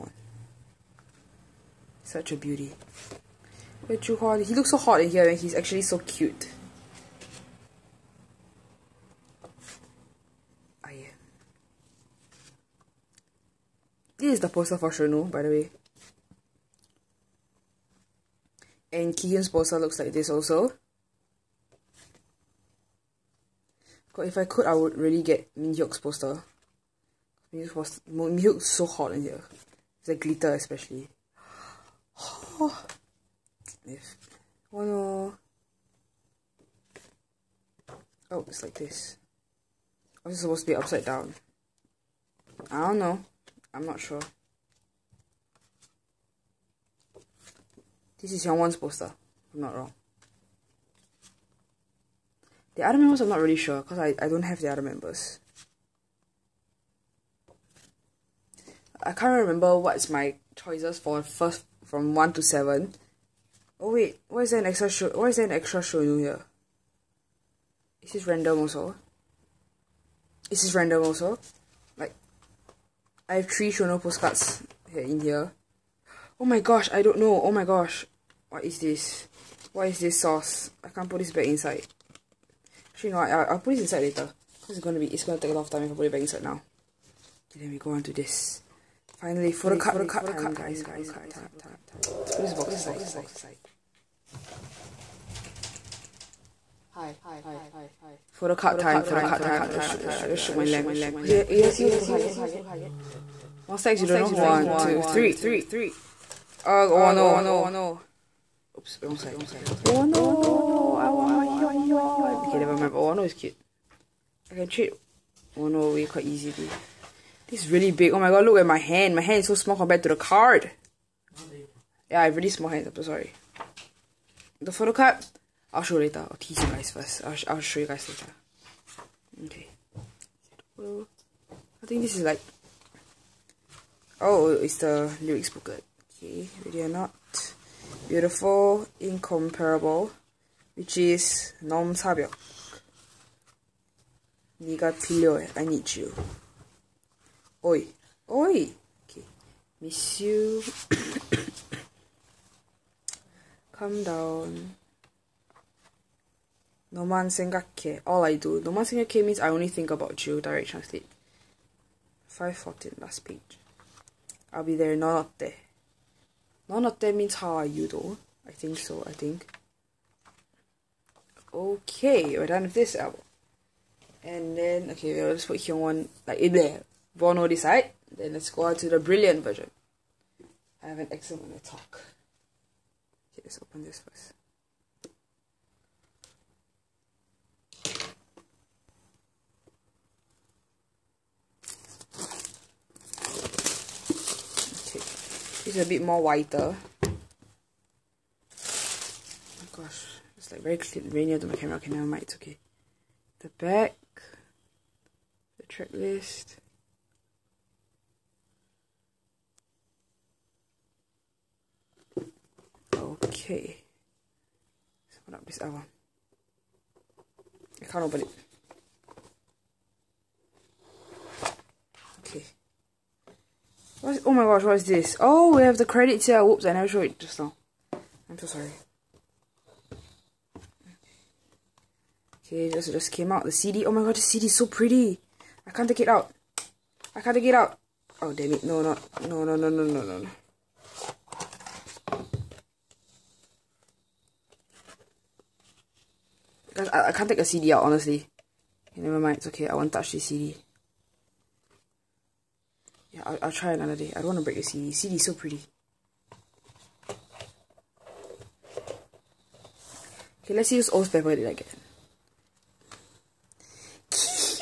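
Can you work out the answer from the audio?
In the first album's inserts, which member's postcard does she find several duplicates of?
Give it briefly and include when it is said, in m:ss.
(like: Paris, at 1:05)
Shownu, at 1:13.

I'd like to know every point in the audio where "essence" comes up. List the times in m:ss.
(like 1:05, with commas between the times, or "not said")
not said.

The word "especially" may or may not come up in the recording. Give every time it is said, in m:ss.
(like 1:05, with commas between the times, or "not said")
0:30.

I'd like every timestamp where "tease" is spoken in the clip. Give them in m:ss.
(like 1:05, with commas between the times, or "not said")
2:06.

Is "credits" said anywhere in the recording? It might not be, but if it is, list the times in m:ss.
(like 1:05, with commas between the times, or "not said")
3:45.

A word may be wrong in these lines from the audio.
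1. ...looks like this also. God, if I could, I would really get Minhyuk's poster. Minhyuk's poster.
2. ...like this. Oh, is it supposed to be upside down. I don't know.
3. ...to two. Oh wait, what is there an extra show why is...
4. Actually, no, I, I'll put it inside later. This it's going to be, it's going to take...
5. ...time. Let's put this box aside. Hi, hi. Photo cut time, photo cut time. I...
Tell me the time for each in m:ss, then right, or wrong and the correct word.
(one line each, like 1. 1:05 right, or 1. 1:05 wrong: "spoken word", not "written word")
1. 0:19 right
2. 0:38 right
3. 1:02 wrong: "seven", not "two"
4. 1:23 right
5. 1:31 right.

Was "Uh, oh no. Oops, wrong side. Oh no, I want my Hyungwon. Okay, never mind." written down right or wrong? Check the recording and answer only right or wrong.
right.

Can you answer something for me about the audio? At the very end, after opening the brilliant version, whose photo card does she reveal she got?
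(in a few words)
Kihyun.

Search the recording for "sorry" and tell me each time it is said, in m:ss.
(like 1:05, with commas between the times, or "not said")
2:03, 3:48.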